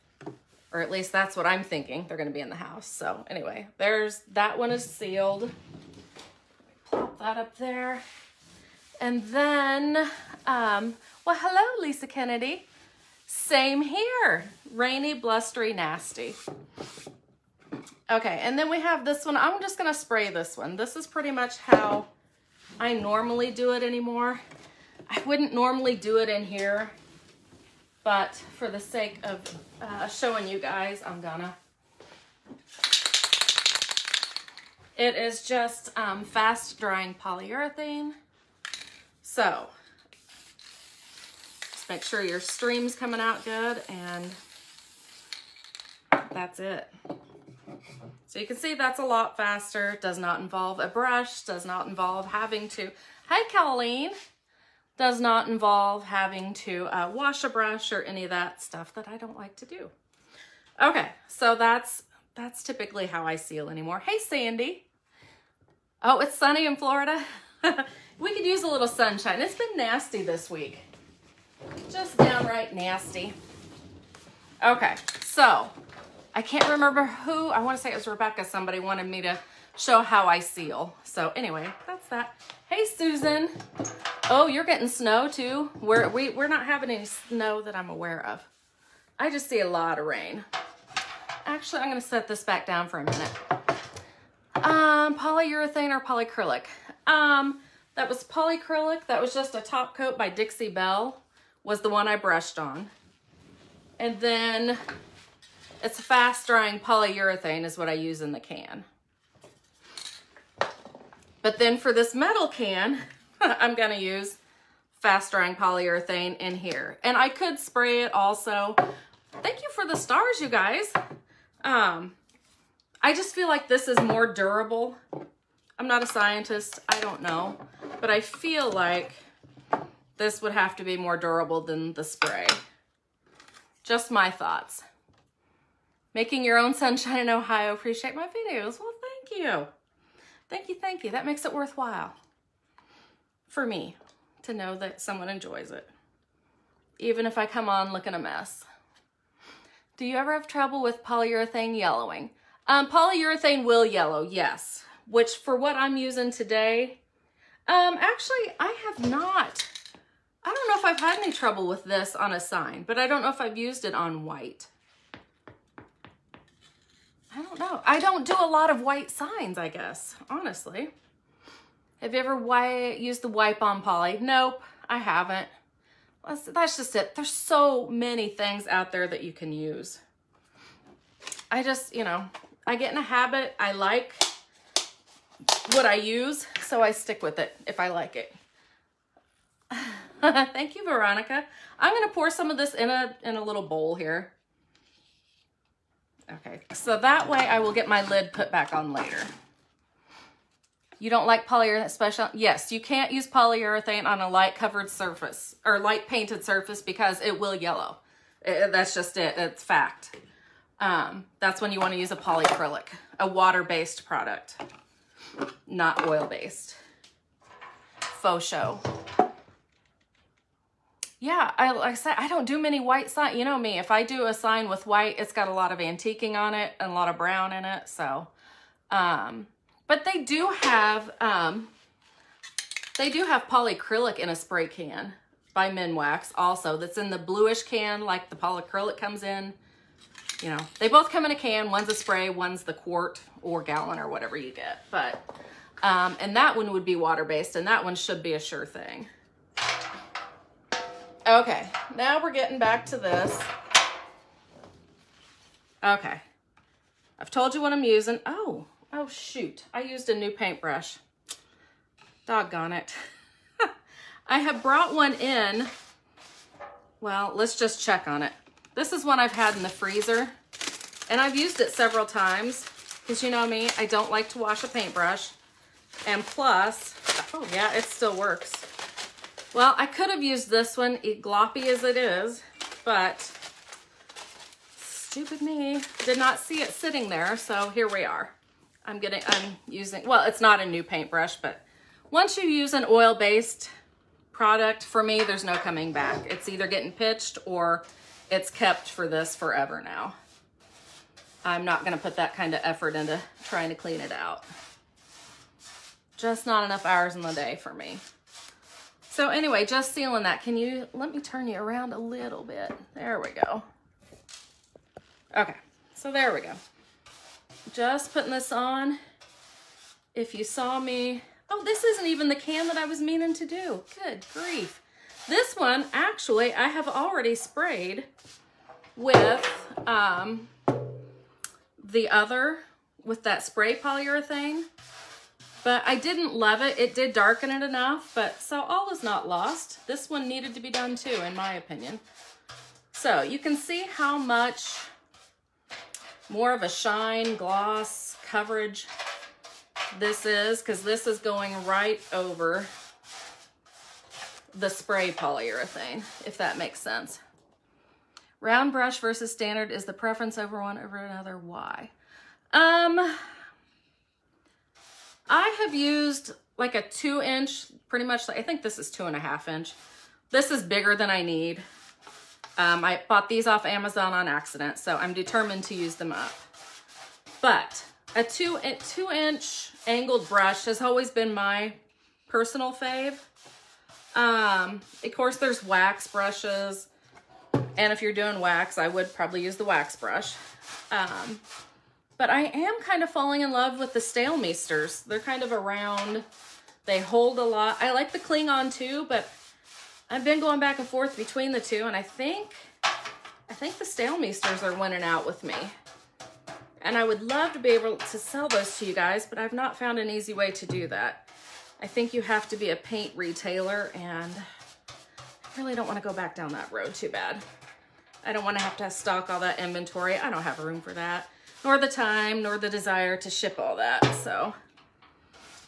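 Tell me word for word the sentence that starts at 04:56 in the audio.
It's either getting pitched or it's kept for this forever now.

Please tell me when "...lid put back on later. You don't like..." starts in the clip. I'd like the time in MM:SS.
03:18.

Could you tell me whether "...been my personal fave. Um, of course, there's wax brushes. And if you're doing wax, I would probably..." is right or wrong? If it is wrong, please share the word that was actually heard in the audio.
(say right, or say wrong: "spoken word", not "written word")
right.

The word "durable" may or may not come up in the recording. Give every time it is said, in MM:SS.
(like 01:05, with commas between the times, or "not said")
02:04, 02:11.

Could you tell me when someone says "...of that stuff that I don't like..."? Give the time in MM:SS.
00:58.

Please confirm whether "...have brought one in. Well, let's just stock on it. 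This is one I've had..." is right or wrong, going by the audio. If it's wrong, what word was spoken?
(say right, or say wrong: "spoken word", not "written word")
wrong: "check", not "stock".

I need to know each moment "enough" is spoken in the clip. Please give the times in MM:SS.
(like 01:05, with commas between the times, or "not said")
05:06, 05:37.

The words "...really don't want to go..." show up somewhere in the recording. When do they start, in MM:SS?
06:55.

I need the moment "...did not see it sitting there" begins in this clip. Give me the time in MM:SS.
04:46.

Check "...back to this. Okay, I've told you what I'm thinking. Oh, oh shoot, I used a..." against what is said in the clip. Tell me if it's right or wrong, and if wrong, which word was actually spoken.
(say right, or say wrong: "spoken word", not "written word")
wrong: "using", not "thinking".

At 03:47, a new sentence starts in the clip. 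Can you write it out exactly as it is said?
So, um, but they do have, um, they do have polyacrylic in a spray can by Minwax also.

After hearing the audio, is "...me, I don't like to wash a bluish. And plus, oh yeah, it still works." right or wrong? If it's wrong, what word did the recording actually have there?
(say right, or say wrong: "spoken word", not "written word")
wrong: "paintbrush", not "bluish".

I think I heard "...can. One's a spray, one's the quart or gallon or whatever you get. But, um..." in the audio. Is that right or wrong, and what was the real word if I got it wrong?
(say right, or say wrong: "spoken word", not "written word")
right.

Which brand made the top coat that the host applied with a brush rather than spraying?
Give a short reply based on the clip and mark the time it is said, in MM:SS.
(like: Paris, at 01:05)
Dixie Belle, at 01:40.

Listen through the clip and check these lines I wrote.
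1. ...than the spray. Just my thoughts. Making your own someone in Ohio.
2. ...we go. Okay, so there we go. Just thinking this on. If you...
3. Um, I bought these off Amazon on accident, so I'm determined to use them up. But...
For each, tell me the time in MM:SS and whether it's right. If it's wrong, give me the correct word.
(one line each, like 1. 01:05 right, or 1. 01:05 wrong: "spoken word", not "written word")
1. 02:11 wrong: "sunshine", not "someone"
2. 05:13 wrong: "putting", not "thinking"
3. 06:12 right.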